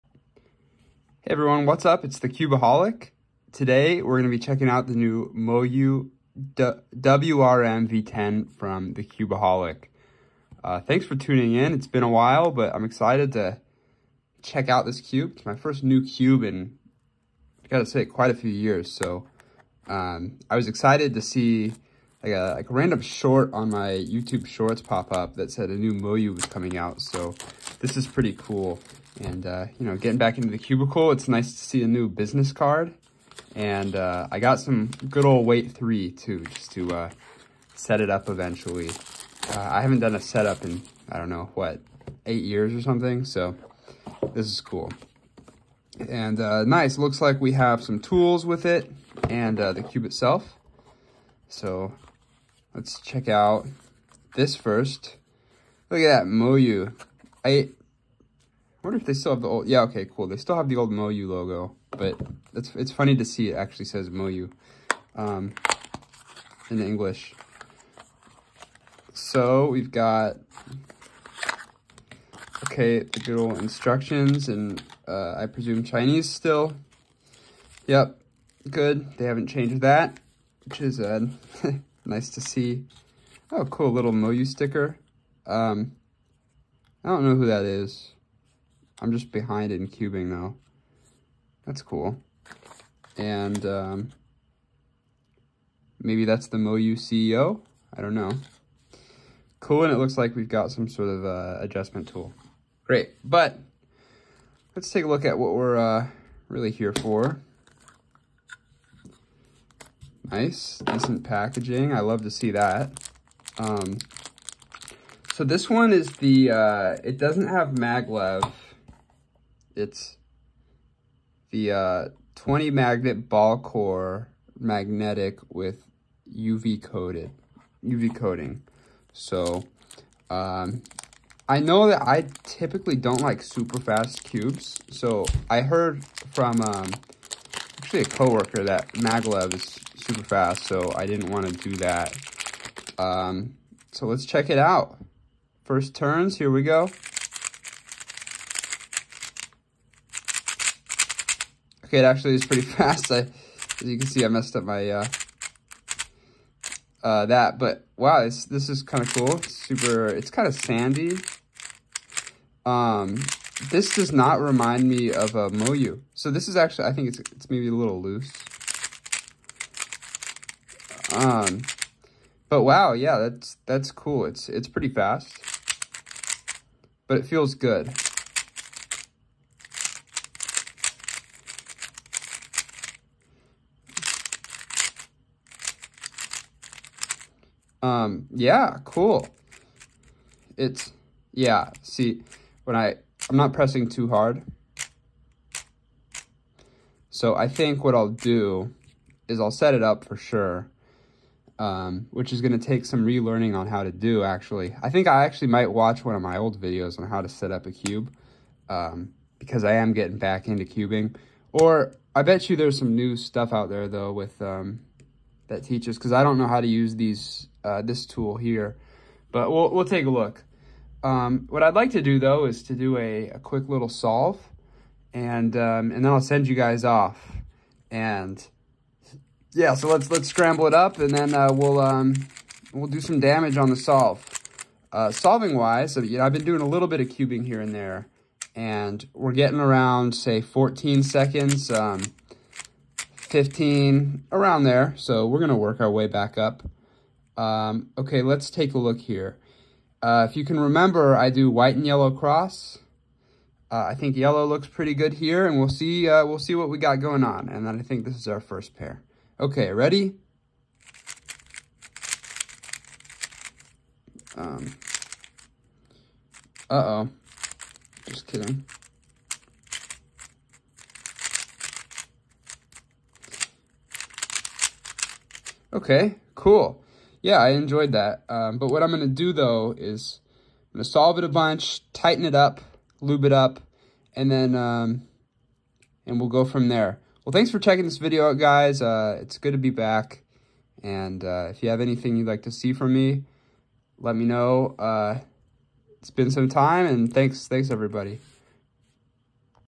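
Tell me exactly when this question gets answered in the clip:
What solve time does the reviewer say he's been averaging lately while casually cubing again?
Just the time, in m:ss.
4:00.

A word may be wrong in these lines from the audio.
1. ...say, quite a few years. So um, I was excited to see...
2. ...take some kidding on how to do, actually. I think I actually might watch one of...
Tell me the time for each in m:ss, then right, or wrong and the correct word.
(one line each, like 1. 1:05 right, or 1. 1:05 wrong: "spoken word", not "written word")
1. 0:17 right
2. 3:22 wrong: "relearning", not "kidding".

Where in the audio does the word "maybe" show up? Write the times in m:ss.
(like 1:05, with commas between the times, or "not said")
1:36, 2:47.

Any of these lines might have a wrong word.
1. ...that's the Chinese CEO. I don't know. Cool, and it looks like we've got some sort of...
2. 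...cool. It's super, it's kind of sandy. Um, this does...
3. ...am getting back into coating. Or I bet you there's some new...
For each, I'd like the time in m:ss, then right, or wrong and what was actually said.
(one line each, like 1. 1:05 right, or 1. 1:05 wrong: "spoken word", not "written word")
1. 1:36 wrong: "Moyu", not "Chinese"
2. 2:39 right
3. 3:29 wrong: "cubing", not "coating".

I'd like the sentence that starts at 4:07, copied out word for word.
Um, okay, let's take a look here.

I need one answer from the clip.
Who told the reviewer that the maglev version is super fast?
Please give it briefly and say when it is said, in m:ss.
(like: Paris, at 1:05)
a coworker, at 2:18.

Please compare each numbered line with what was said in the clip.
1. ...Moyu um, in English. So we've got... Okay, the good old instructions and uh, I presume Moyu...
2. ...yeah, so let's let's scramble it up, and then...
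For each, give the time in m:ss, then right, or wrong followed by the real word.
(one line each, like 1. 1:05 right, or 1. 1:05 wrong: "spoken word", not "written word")
1. 1:04 wrong: "Chinese", not "Moyu"
2. 3:49 right.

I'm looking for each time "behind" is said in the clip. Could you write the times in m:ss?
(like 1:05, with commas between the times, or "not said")
1:29.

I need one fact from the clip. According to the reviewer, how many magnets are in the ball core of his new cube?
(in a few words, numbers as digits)
20.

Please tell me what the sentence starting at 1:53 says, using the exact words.
Um, so this one is the, uh, it doesn't have maglev.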